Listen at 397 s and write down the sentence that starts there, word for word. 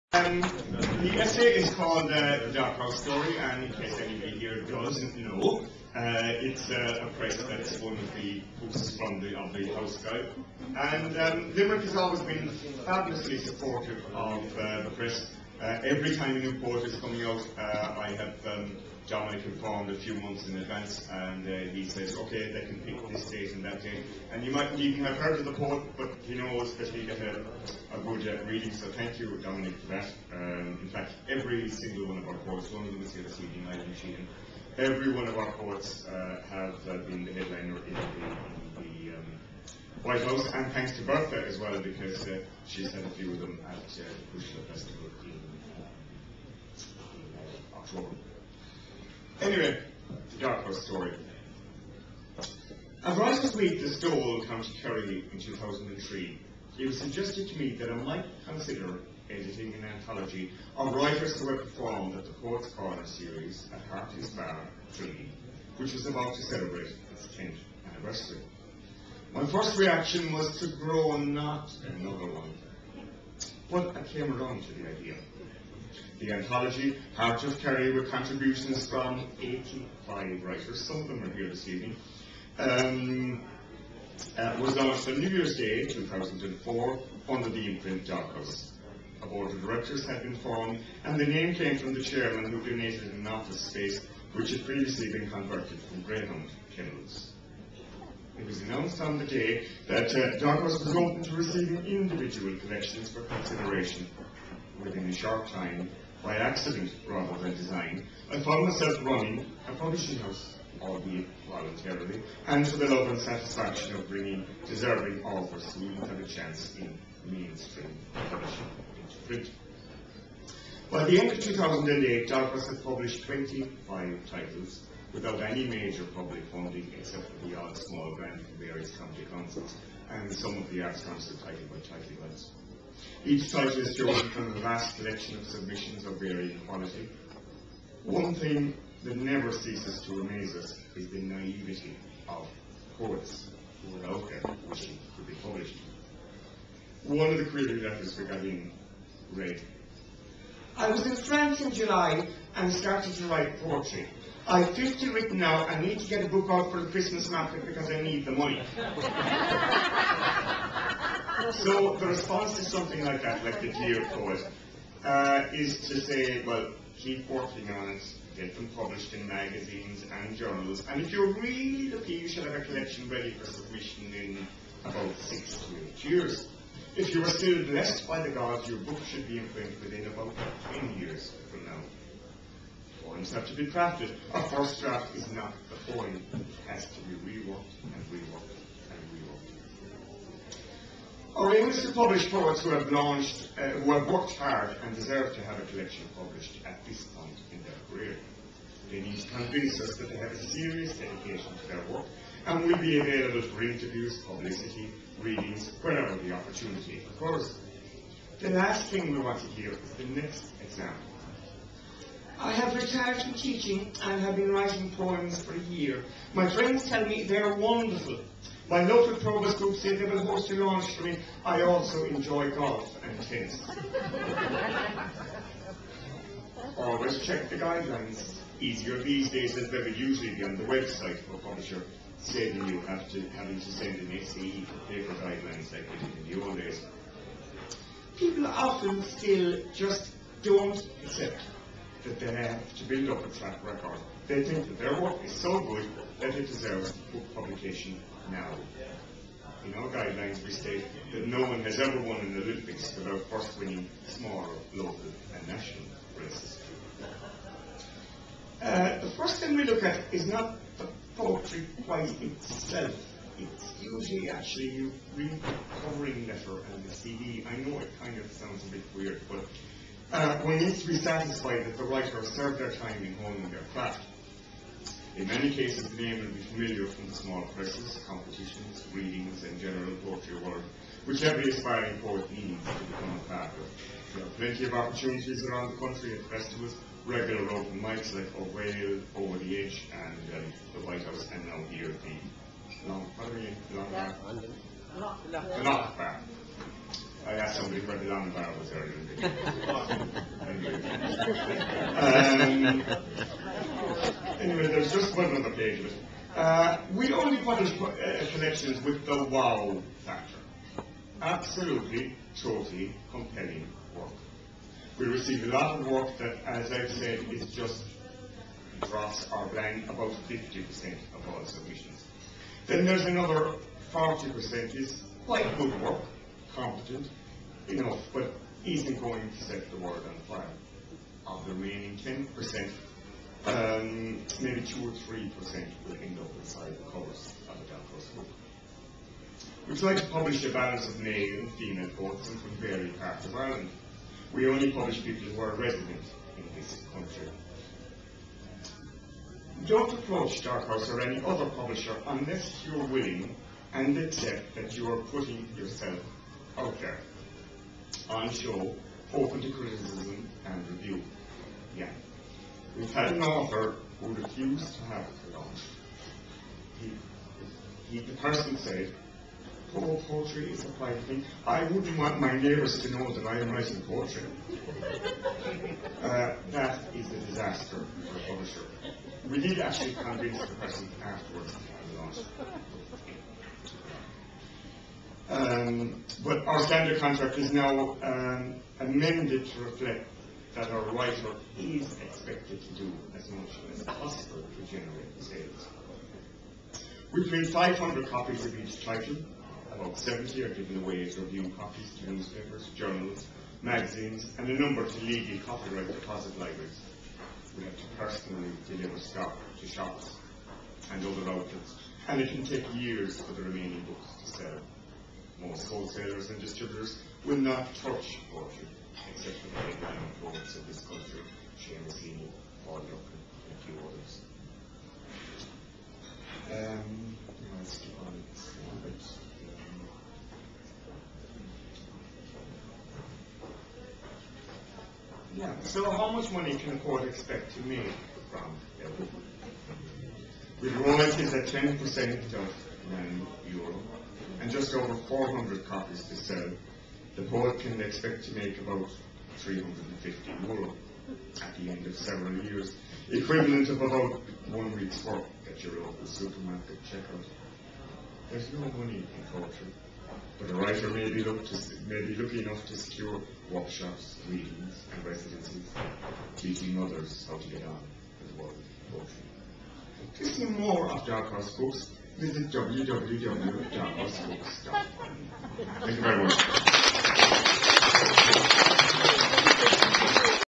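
We print 500 copies of each title.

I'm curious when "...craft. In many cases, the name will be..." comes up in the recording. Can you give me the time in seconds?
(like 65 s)
273 s.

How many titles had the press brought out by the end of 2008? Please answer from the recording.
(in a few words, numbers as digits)
25.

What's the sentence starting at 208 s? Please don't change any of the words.
The last thing we want to hear is the next example.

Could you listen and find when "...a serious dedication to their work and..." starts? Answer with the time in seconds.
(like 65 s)
200 s.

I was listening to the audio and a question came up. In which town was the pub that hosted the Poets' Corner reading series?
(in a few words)
Tralee.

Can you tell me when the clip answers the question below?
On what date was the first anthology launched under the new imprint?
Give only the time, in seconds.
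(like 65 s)
85 s.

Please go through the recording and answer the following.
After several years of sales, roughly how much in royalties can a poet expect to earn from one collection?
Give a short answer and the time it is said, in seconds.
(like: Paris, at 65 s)
350 euro, at 449 s.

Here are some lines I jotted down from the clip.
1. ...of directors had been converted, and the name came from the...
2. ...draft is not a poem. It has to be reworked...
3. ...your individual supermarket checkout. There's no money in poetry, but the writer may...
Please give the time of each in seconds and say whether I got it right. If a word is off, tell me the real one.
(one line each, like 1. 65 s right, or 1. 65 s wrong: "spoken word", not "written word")
1. 89 s wrong: "formed", not "converted"
2. 184 s right
3. 455 s wrong: "local", not "individual".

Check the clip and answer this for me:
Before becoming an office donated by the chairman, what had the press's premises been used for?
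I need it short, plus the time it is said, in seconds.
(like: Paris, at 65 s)
greyhound kennels, at 96 s.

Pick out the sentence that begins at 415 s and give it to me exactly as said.
Most wholesalers and distributors will not touch poetry of this country, and a few others.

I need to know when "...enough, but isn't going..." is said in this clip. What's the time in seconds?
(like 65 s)
327 s.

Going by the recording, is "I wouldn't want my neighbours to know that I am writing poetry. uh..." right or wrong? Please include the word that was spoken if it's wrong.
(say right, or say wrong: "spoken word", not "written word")
right.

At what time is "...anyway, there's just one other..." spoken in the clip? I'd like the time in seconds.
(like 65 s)
304 s.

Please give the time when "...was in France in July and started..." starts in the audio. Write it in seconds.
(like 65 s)
150 s.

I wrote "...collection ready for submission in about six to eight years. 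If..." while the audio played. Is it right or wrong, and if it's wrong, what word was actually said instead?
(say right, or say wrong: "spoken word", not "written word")
right.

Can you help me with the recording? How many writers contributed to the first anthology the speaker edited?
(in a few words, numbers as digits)
85.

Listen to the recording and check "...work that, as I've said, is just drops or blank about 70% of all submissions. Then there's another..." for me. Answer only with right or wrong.
wrong.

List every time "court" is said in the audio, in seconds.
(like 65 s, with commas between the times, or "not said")
436 s.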